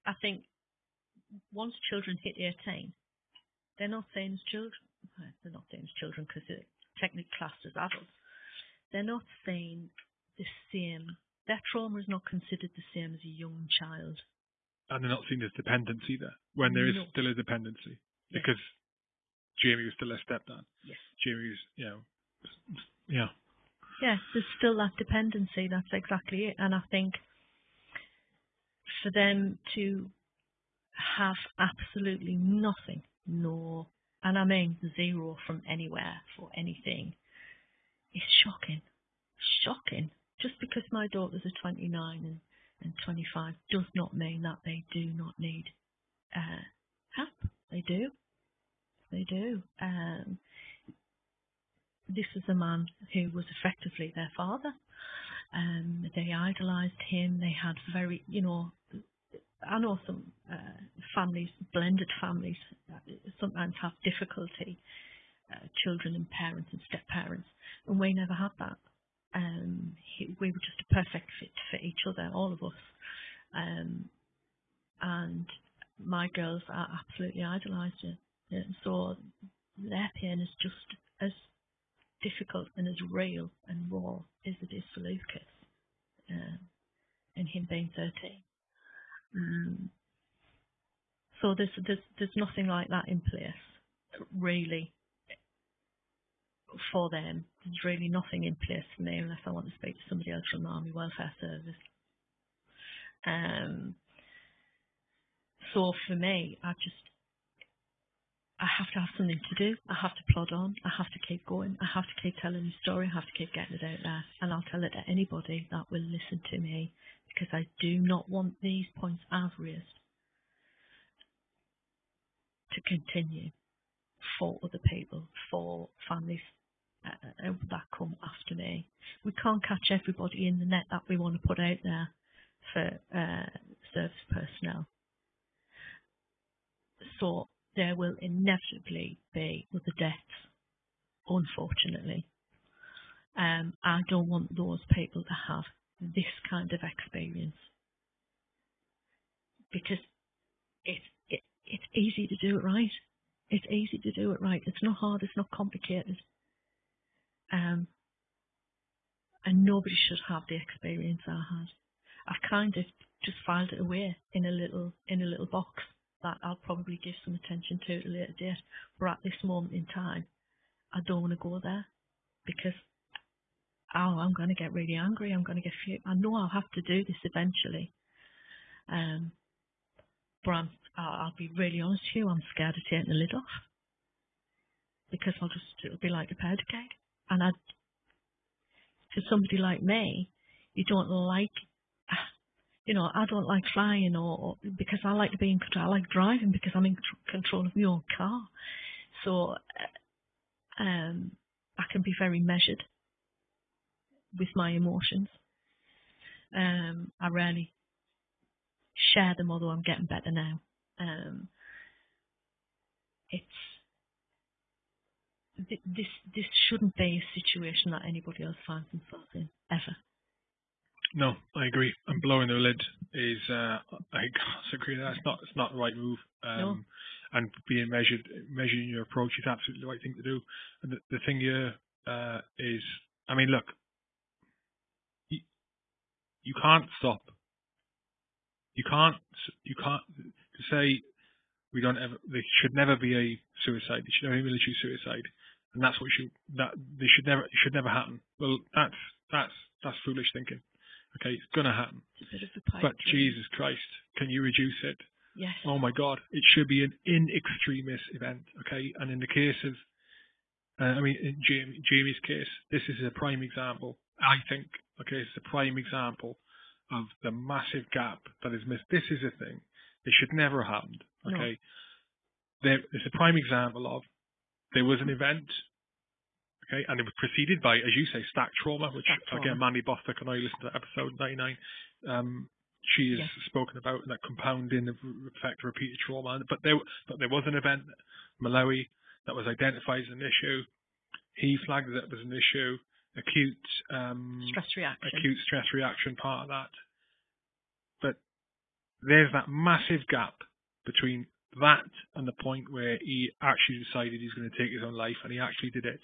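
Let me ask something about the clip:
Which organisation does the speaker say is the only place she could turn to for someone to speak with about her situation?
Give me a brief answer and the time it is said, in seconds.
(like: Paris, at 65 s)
Army Welfare Service, at 100 s.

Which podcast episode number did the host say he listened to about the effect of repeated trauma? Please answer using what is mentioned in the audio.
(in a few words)
99.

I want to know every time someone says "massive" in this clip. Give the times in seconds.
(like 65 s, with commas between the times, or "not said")
267 s, 299 s.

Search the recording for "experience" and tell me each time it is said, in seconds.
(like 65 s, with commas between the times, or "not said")
146 s, 160 s.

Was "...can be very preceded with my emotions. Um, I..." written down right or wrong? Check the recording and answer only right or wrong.
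wrong.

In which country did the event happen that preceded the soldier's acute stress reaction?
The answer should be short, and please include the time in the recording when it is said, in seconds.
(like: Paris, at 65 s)
Malawi, at 288 s.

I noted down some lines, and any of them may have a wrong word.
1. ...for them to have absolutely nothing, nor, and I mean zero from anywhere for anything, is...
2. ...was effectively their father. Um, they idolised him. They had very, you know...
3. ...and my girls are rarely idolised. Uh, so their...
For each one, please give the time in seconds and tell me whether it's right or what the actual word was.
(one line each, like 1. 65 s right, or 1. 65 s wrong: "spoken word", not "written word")
1. 29 s right
2. 53 s right
3. 75 s wrong: "absolutely", not "rarely".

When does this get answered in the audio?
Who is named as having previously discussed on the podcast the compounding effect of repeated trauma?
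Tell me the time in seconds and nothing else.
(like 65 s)
279 s.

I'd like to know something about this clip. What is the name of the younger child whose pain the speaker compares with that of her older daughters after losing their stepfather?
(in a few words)
Lucas.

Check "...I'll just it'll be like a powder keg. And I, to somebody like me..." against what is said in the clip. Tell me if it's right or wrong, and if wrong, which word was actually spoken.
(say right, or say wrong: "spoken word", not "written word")
right.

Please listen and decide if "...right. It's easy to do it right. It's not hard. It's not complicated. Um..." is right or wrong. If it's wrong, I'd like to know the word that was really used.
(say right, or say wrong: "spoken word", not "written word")
right.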